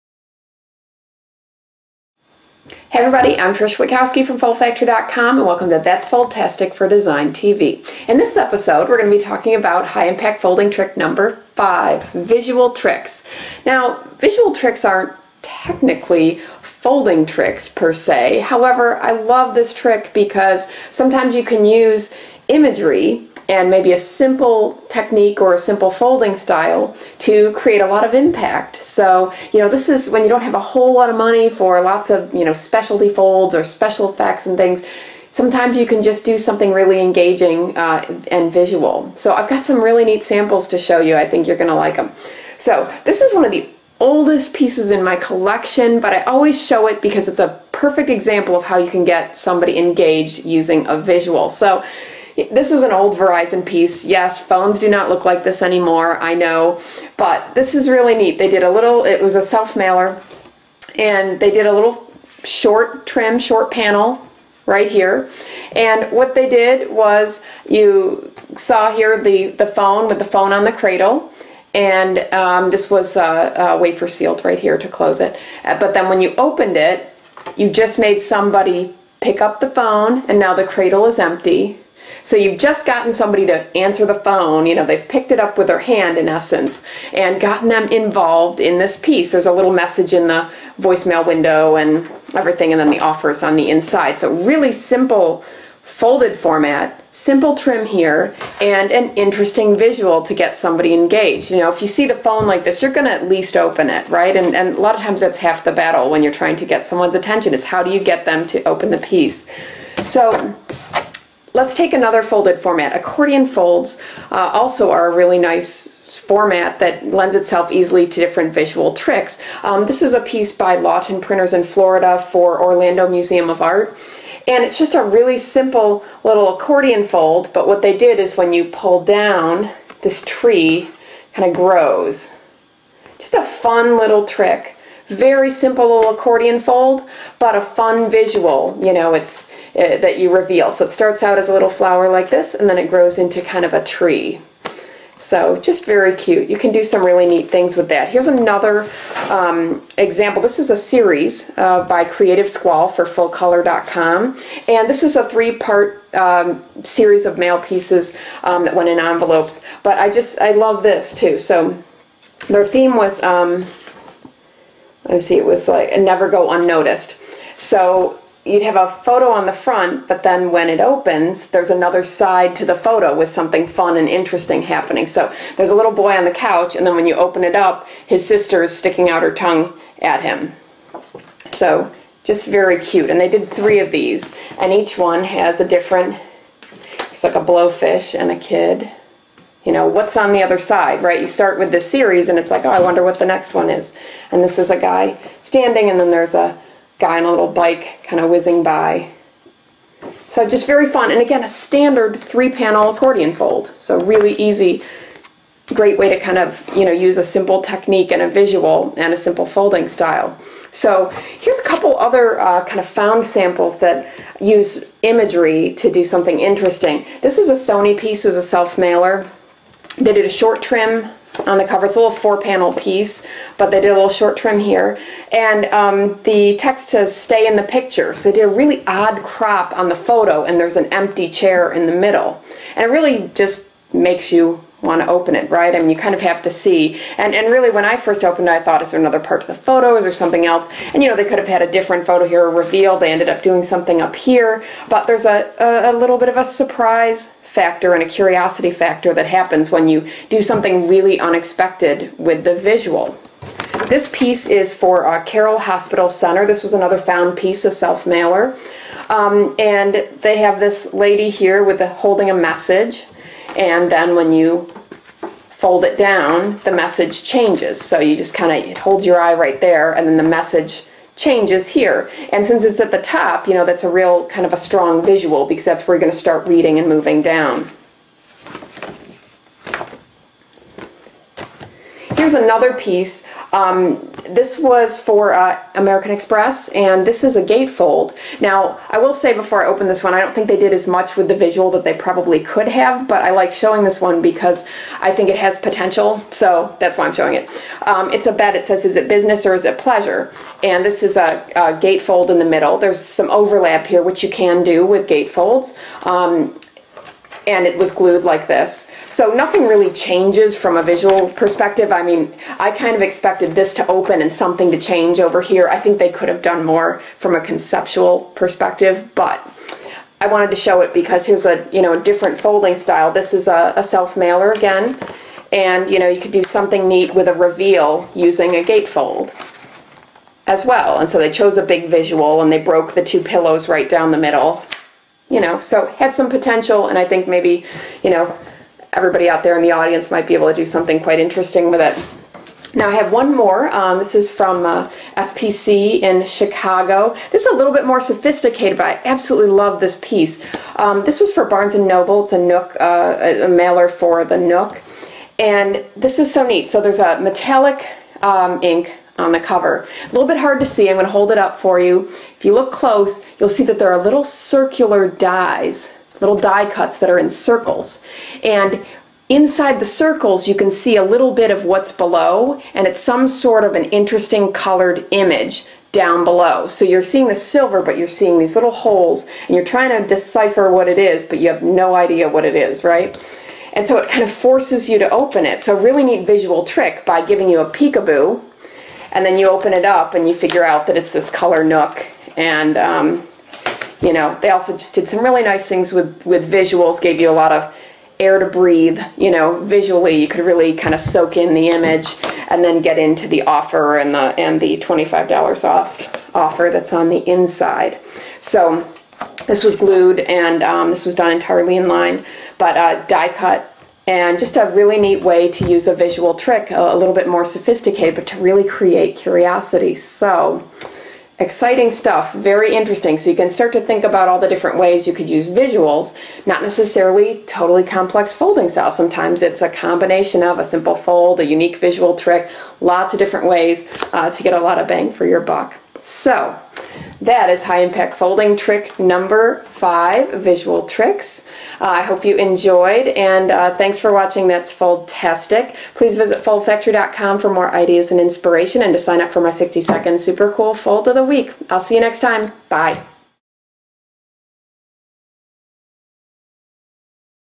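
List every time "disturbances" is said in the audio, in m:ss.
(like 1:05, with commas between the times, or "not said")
not said.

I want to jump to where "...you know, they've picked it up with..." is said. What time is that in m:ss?
1:24.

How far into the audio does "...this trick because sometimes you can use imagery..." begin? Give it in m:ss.
0:19.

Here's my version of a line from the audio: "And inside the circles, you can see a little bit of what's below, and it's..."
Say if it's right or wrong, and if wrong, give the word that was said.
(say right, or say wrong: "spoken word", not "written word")
right.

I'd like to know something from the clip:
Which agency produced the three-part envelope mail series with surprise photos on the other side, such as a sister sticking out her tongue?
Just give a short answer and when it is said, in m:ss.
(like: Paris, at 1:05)
Creative Squall, at 2:32.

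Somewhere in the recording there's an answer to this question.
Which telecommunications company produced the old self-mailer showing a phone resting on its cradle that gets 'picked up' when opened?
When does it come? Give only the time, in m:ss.
0:53.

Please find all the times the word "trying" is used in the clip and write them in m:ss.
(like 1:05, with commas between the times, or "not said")
1:46, 6:19.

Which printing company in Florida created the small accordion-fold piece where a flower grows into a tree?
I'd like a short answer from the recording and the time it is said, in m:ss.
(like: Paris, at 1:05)
Lawton Printers, at 2:00.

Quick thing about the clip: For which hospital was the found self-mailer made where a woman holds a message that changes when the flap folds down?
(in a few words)
Carroll Hospital Center.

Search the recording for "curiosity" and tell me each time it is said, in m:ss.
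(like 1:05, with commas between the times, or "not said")
4:08, 6:59.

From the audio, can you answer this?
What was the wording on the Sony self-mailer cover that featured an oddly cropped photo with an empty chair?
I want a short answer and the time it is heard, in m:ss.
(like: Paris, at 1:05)
Stay in the picture, at 3:47.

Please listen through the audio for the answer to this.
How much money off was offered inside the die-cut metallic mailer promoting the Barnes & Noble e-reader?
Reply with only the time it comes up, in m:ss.
6:44.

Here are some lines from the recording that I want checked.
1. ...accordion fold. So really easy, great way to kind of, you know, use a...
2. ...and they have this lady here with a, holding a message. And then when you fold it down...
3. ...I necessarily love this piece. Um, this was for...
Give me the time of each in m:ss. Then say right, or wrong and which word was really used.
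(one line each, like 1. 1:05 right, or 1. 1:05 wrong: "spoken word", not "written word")
1. 3:22 right
2. 4:19 right
3. 5:48 wrong: "absolutely", not "necessarily".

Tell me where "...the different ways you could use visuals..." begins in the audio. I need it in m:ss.
7:04.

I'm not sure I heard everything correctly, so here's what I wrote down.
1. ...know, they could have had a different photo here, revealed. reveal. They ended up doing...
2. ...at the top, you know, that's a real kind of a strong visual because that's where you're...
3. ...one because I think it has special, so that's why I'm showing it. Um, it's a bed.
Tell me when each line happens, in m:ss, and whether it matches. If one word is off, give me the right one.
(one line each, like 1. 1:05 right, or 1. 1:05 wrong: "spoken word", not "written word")
1. 4:01 right
2. 4:32 right
3. 4:53 wrong: "potential", not "special".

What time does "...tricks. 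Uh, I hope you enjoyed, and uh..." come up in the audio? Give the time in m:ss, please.
7:20.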